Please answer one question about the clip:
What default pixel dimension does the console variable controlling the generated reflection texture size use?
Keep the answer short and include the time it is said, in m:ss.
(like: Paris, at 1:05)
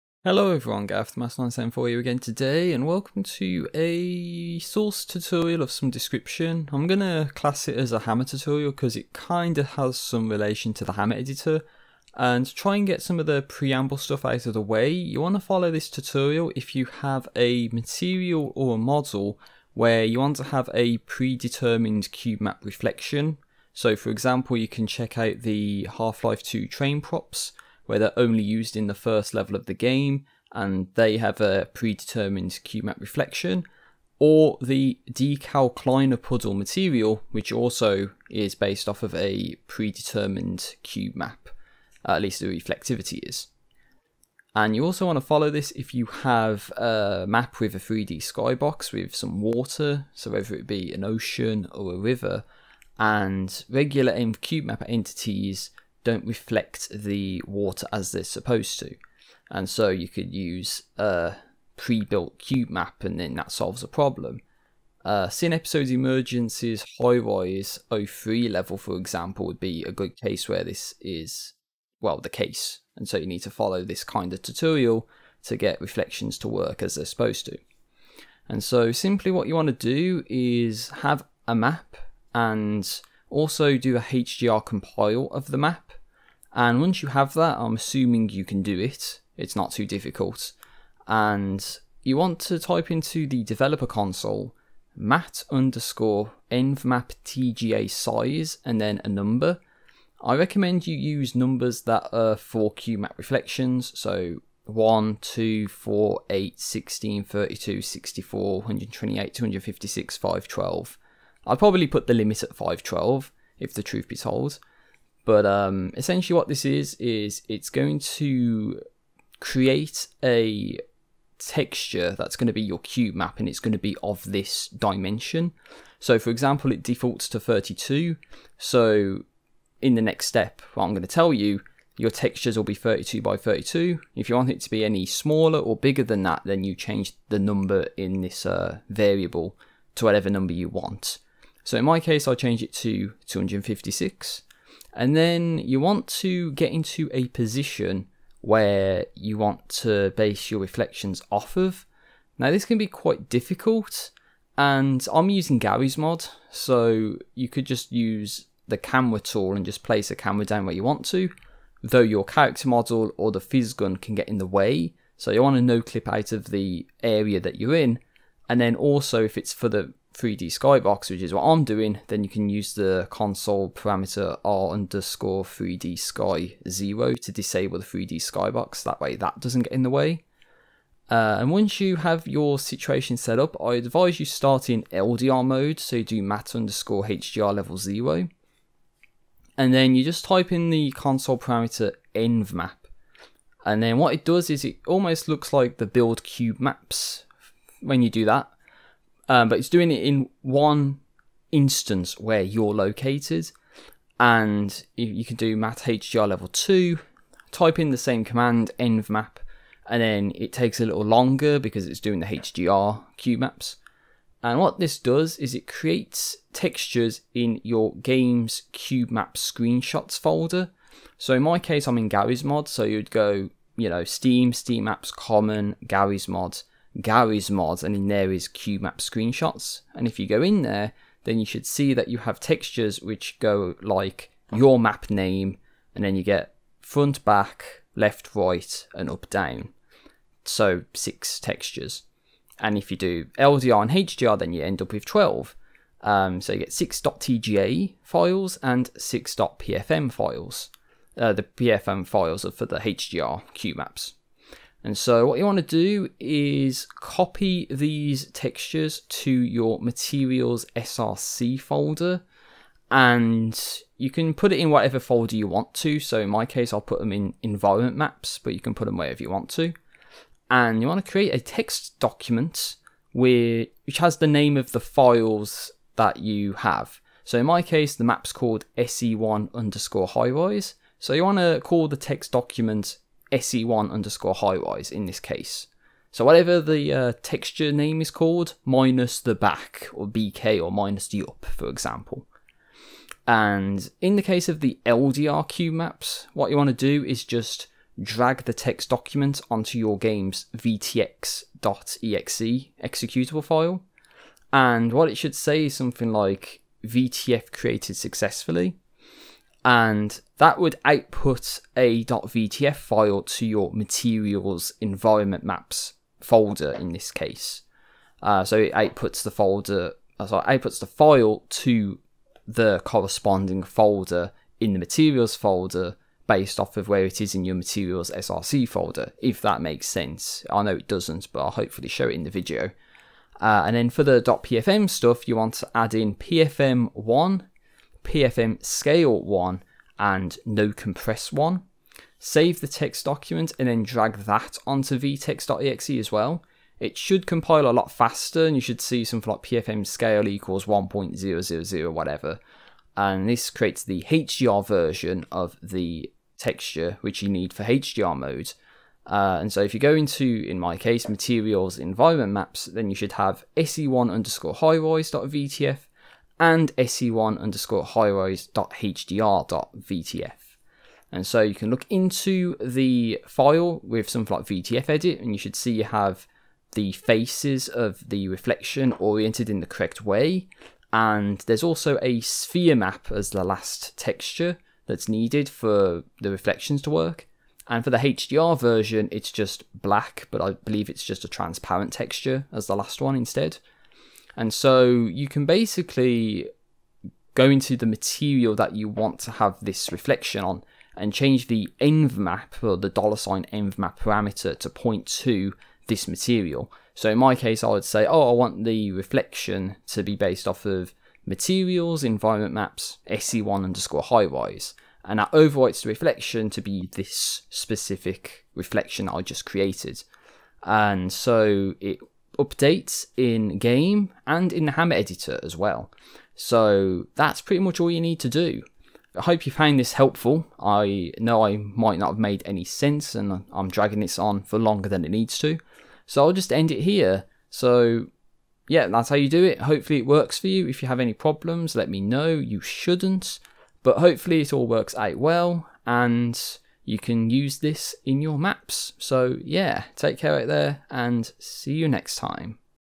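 32, at 2:06.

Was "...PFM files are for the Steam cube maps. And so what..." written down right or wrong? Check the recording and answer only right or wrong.
wrong.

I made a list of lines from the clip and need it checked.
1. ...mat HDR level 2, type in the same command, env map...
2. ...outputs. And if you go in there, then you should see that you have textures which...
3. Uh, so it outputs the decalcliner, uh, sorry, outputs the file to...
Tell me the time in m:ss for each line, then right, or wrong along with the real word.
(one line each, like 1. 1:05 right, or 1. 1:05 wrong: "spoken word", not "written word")
1. 3:25 right
2. 3:48 wrong: "screenshots", not "outputs"
3. 5:18 wrong: "folder", not "decalcliner".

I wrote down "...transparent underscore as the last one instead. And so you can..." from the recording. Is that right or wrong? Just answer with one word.
wrong.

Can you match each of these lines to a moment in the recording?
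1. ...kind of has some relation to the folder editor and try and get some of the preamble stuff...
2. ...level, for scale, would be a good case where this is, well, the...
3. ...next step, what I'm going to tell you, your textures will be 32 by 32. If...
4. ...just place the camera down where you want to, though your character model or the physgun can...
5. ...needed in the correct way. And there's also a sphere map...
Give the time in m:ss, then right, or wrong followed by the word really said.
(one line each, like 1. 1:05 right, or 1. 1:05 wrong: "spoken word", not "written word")
1. 0:09 wrong: "hammer", not "folder"
2. 1:08 wrong: "example", not "scale"
3. 2:10 right
4. 2:39 right
5. 6:18 wrong: "oriented", not "needed".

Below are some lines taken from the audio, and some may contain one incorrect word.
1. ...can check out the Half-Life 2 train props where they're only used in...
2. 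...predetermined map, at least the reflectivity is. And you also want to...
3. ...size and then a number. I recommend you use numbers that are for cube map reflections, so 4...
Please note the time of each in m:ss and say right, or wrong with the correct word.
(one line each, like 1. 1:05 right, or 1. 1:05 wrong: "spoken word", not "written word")
1. 0:24 right
2. 0:39 right
3. 1:37 wrong: "1", not "4".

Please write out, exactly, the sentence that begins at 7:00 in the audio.
And so it updates in game and in the hammer editor as well.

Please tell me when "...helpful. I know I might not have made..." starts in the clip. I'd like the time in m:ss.
7:09.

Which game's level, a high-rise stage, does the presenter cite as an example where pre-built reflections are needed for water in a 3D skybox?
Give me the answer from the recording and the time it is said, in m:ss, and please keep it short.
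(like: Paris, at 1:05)
Sin Episodes Emergence, at 1:05.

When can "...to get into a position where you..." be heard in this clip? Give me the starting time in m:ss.
2:26.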